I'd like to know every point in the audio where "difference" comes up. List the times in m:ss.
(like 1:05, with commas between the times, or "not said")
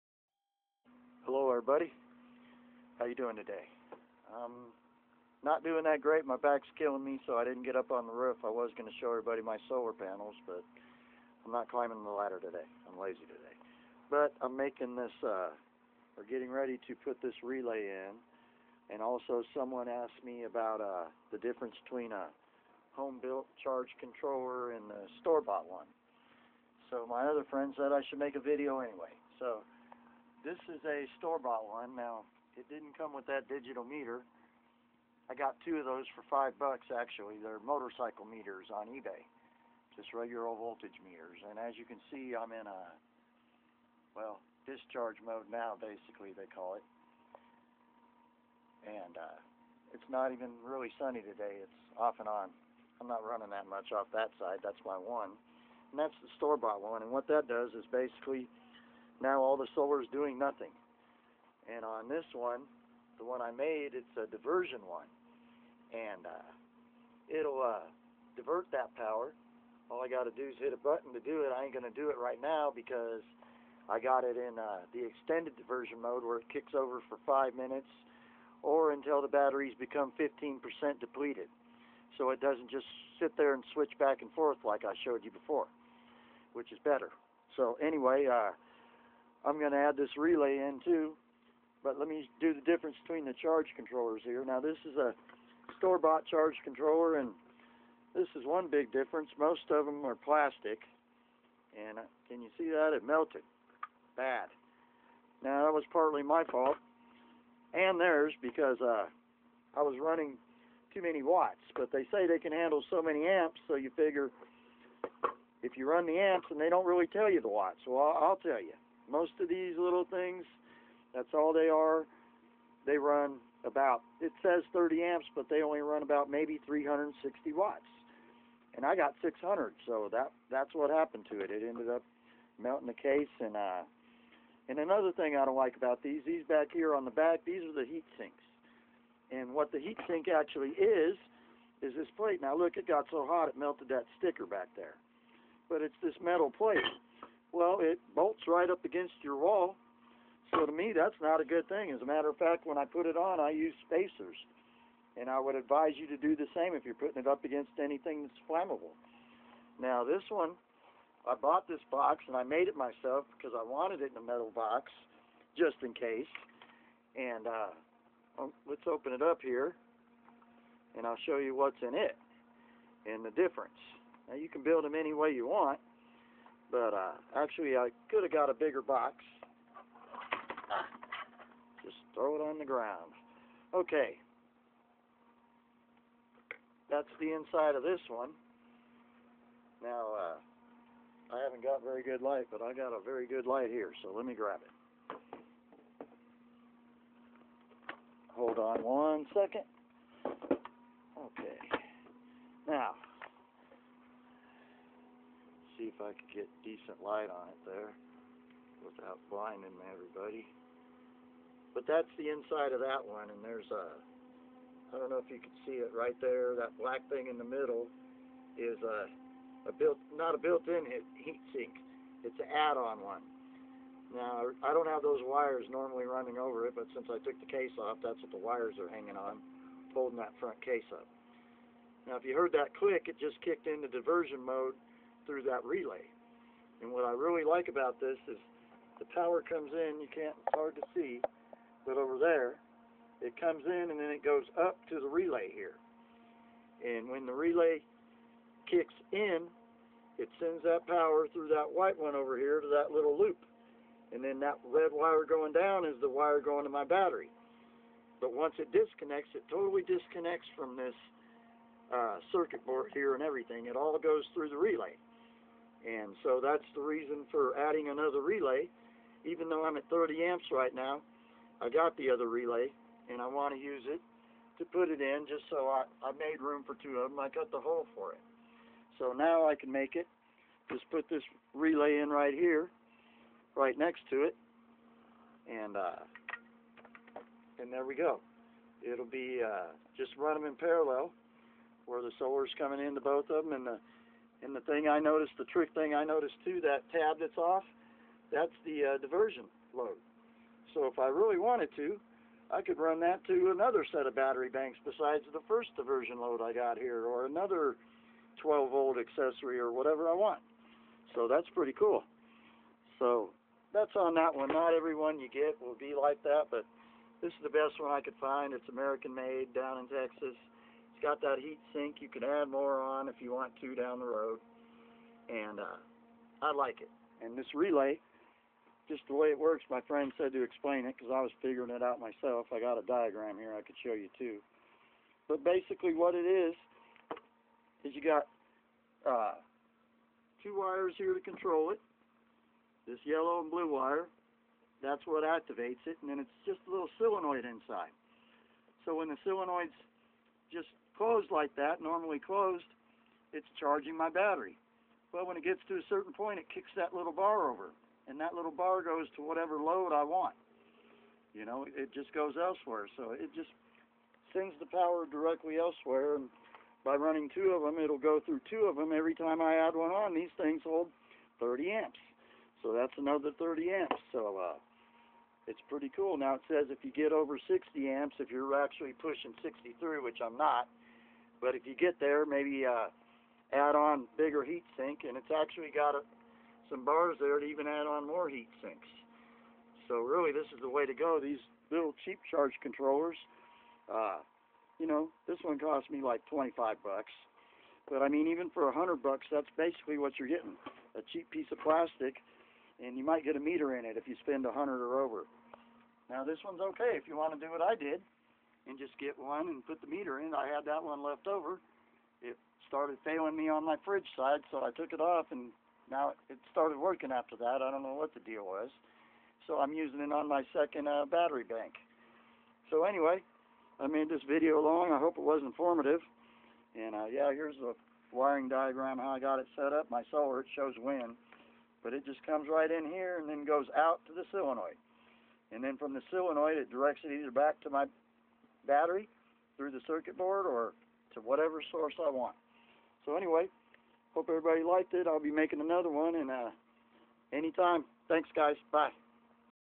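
0:21, 1:32, 1:38, 2:53.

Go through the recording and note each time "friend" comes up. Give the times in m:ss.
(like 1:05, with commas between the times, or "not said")
0:27, 5:29.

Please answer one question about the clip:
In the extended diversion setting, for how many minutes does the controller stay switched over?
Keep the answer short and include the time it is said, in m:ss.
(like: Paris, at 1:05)
5 minutes, at 1:17.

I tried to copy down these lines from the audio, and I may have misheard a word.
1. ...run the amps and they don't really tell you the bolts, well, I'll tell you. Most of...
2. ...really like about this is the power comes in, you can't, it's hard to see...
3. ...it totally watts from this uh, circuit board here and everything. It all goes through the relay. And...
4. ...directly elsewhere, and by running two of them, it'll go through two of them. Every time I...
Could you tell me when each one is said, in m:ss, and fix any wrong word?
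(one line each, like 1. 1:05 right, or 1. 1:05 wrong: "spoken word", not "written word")
1. 1:55 wrong: "watts", not "bolts"
2. 3:57 right
3. 4:19 wrong: "disconnects", not "watts"
4. 6:05 right.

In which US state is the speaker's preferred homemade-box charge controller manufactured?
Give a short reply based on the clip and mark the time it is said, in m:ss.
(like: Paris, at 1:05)
Texas, at 5:19.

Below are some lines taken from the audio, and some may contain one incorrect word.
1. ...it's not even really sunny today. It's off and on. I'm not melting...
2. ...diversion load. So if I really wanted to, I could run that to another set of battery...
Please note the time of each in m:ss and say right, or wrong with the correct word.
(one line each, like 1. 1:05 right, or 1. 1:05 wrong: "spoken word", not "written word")
1. 0:49 wrong: "running", not "melting"
2. 4:58 right.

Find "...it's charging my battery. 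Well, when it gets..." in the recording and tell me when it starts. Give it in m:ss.
5:53.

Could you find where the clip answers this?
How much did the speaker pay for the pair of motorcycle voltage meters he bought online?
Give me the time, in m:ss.
0:36.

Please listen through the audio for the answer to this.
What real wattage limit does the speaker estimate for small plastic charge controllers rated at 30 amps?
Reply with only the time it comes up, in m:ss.
2:06.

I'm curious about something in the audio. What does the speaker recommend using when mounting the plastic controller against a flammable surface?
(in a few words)
Spacers.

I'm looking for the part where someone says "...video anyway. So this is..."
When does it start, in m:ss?
0:28.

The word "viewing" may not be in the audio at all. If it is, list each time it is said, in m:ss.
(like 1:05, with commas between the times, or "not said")
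not said.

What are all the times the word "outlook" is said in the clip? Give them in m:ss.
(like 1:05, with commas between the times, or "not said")
not said.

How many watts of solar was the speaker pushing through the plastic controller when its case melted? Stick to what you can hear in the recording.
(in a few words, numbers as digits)
600.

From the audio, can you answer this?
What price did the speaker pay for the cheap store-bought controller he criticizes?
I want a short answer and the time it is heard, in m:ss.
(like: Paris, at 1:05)
$25, at 6:36.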